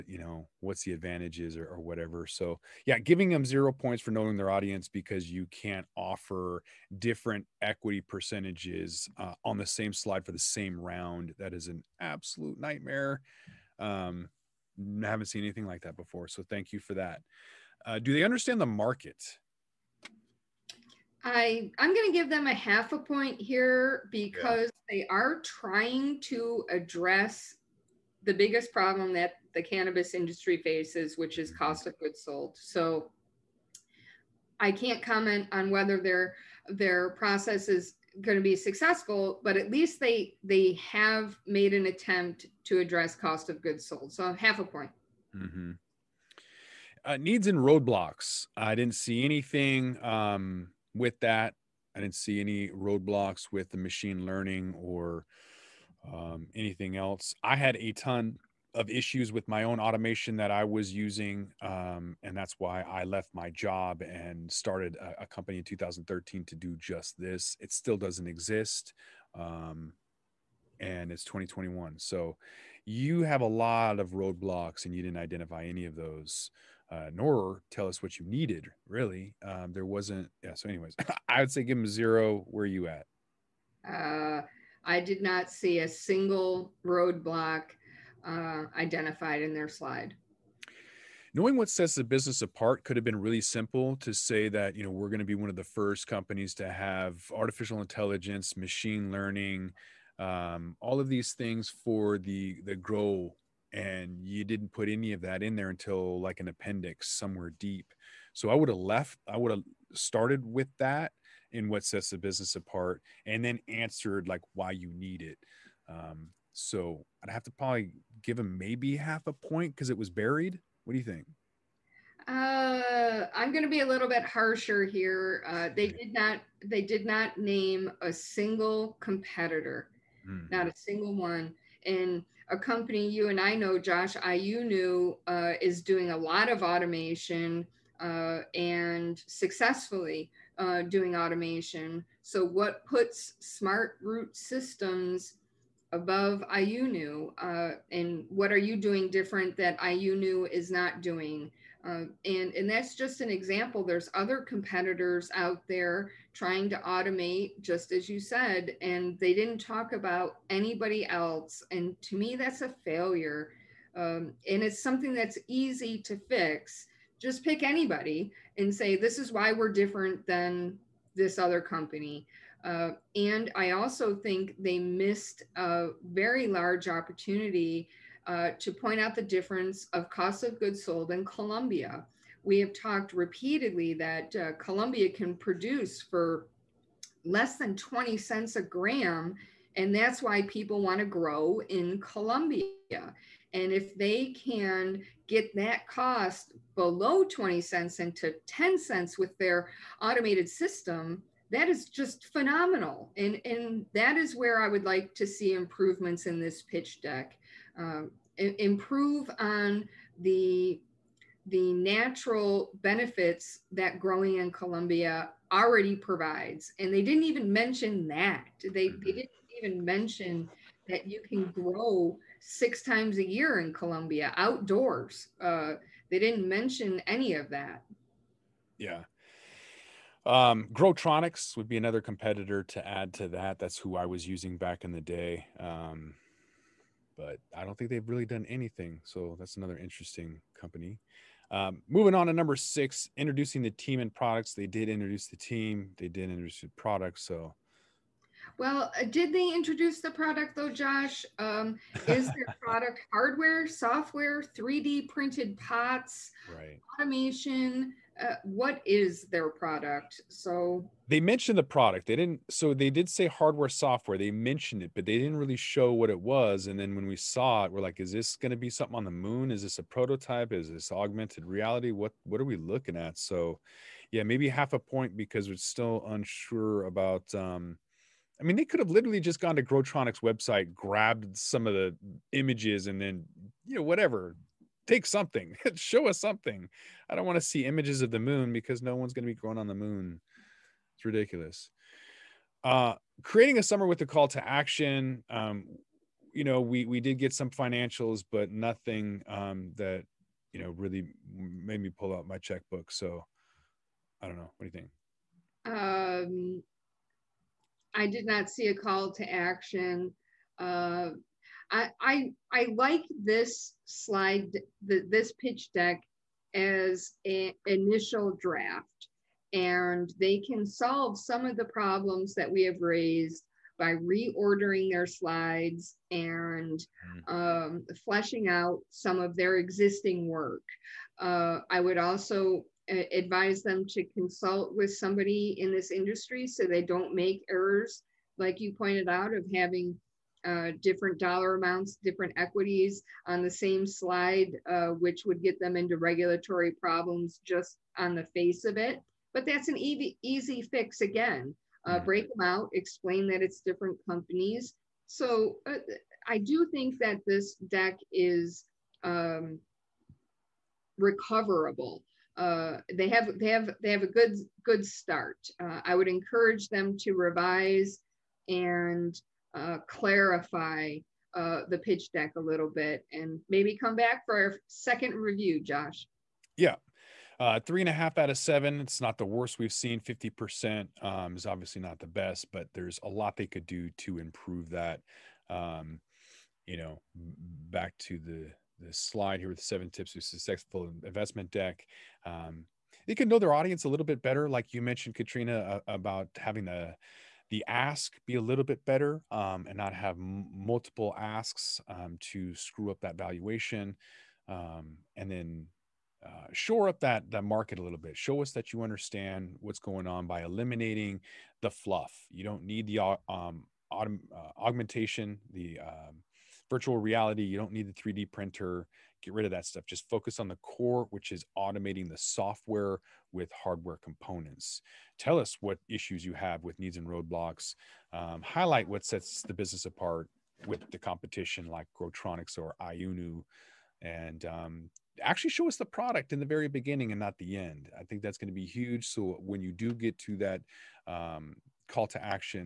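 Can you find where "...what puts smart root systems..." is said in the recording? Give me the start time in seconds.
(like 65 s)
142 s.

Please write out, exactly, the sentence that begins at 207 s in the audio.
Um, improve on the the natural benefits that growing in Colombia already provides.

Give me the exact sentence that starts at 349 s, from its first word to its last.
But that's an easy, easy fix again.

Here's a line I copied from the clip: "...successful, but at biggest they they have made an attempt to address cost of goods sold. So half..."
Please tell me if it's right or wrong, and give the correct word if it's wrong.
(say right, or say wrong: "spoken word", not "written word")
wrong: "least", not "biggest".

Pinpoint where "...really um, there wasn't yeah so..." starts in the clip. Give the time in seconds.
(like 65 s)
78 s.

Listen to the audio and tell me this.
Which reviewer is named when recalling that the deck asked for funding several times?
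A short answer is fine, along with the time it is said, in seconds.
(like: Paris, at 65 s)
Katrina, at 395 s.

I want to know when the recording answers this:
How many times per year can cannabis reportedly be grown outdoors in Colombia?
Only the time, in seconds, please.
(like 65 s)
222 s.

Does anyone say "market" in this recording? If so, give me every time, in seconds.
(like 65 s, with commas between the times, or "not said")
18 s, 407 s.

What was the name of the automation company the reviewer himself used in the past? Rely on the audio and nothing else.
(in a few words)
Growtronics.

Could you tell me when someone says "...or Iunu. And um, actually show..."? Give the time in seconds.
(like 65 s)
432 s.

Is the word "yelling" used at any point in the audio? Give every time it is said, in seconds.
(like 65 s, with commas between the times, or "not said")
not said.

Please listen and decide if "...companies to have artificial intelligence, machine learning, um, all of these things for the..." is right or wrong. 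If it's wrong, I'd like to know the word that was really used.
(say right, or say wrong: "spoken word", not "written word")
right.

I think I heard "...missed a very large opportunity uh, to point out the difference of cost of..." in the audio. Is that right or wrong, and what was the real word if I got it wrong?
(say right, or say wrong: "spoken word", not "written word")
right.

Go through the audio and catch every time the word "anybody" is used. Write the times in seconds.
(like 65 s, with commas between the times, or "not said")
160 s, 167 s.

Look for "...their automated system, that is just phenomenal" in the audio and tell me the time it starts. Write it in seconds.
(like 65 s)
199 s.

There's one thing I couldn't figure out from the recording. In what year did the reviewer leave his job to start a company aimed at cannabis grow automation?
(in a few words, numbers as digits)
2013.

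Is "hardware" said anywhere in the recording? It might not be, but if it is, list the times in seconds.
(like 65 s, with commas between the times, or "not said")
253 s, 263 s, 423 s.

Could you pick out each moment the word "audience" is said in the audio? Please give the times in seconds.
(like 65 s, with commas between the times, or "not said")
4 s, 393 s.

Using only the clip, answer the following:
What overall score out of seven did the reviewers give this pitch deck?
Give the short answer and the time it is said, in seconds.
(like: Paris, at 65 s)
3.5, at 377 s.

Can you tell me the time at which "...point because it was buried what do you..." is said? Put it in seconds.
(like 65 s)
119 s.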